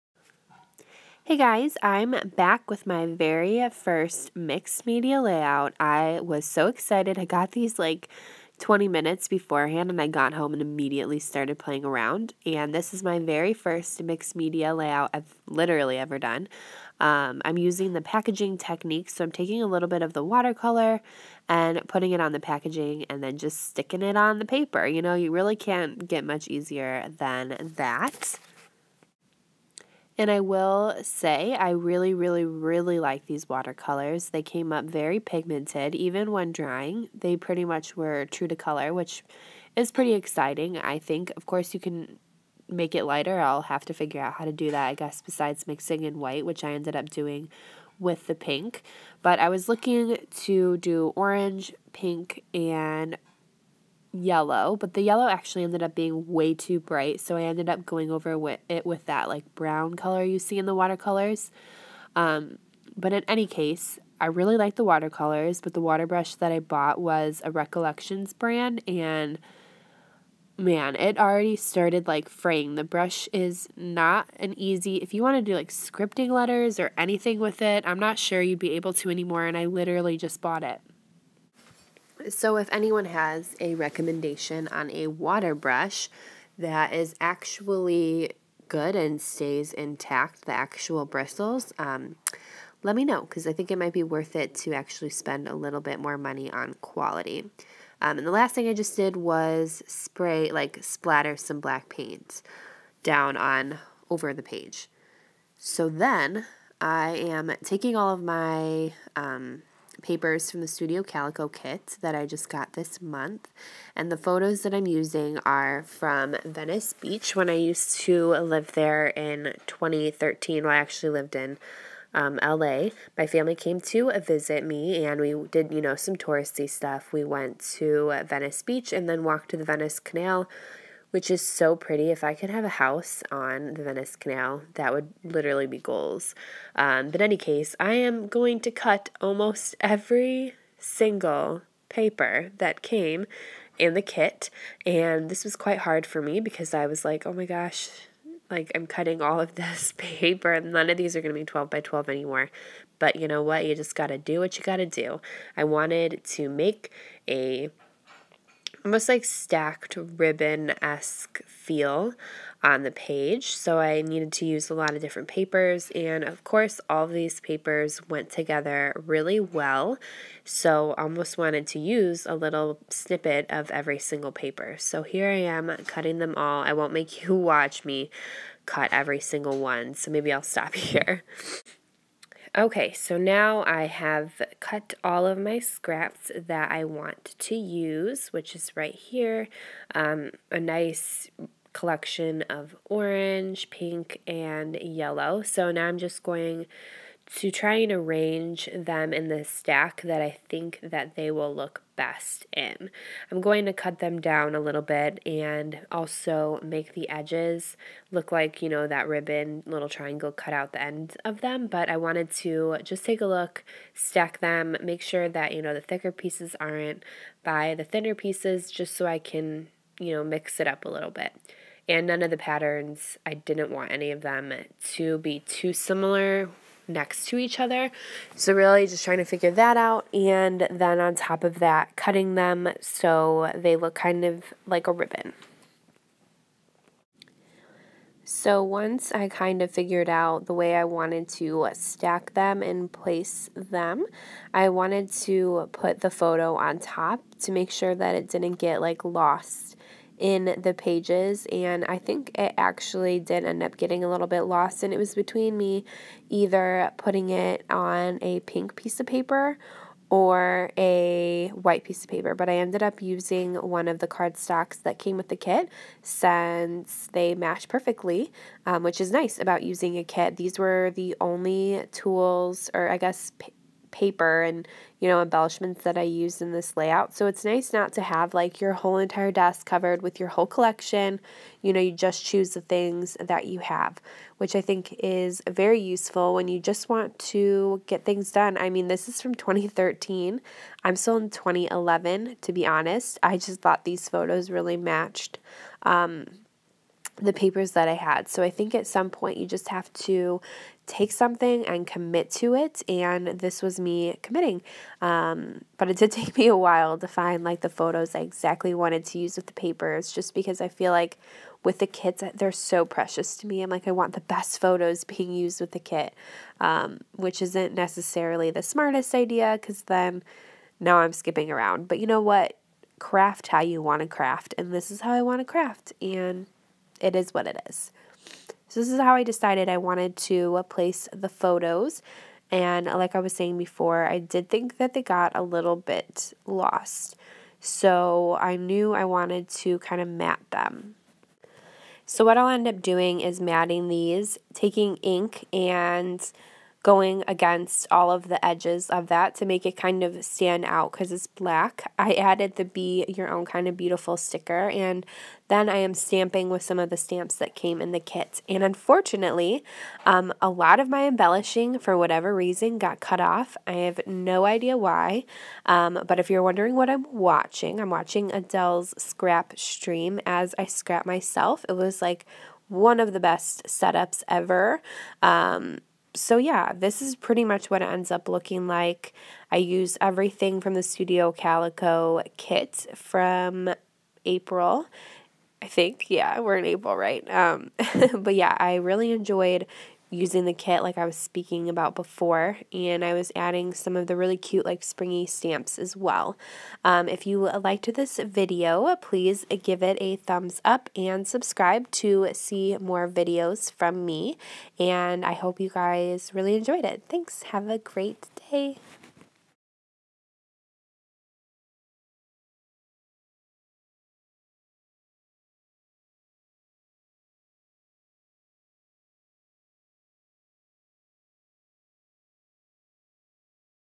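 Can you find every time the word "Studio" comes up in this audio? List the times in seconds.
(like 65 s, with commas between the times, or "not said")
110 s, 380 s.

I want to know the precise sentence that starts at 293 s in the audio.
I just thought these photos really matched.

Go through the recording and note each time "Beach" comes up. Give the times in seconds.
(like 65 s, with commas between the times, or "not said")
116 s, 128 s.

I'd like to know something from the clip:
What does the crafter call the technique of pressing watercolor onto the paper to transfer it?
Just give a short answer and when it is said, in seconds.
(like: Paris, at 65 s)
packaging technique, at 18 s.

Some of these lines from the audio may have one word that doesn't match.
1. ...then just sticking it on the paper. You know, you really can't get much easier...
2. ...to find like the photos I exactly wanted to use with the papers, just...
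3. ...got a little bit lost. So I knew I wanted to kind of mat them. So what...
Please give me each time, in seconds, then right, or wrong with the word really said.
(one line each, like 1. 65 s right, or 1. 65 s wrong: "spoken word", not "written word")
1. 23 s right
2. 306 s right
3. 335 s right.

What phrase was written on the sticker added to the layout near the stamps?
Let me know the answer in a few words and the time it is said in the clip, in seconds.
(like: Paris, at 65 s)
Be Your Own Kind of Beautiful, at 352 s.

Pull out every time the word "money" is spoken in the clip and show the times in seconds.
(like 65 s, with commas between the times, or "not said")
96 s.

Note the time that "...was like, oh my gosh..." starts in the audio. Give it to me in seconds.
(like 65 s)
146 s.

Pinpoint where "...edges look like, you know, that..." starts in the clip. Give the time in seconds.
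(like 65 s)
207 s.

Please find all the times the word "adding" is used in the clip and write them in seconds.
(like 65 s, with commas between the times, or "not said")
393 s.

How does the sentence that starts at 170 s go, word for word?
So almost wanted to use a little snippet of every single paper.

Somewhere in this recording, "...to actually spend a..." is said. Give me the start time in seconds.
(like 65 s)
94 s.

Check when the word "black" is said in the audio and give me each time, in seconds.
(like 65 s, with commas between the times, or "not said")
101 s, 351 s.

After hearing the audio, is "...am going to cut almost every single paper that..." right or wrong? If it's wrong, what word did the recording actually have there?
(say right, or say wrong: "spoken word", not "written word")
right.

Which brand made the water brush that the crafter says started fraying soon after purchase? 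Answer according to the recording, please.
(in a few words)
Recollections.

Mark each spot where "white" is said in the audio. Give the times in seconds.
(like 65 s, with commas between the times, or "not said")
46 s, 261 s.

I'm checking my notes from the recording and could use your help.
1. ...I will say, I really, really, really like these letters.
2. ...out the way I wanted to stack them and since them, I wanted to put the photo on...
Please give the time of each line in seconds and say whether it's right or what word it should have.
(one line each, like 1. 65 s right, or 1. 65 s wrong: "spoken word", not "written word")
1. 30 s wrong: "watercolors", not "letters"
2. 240 s wrong: "place", not "since".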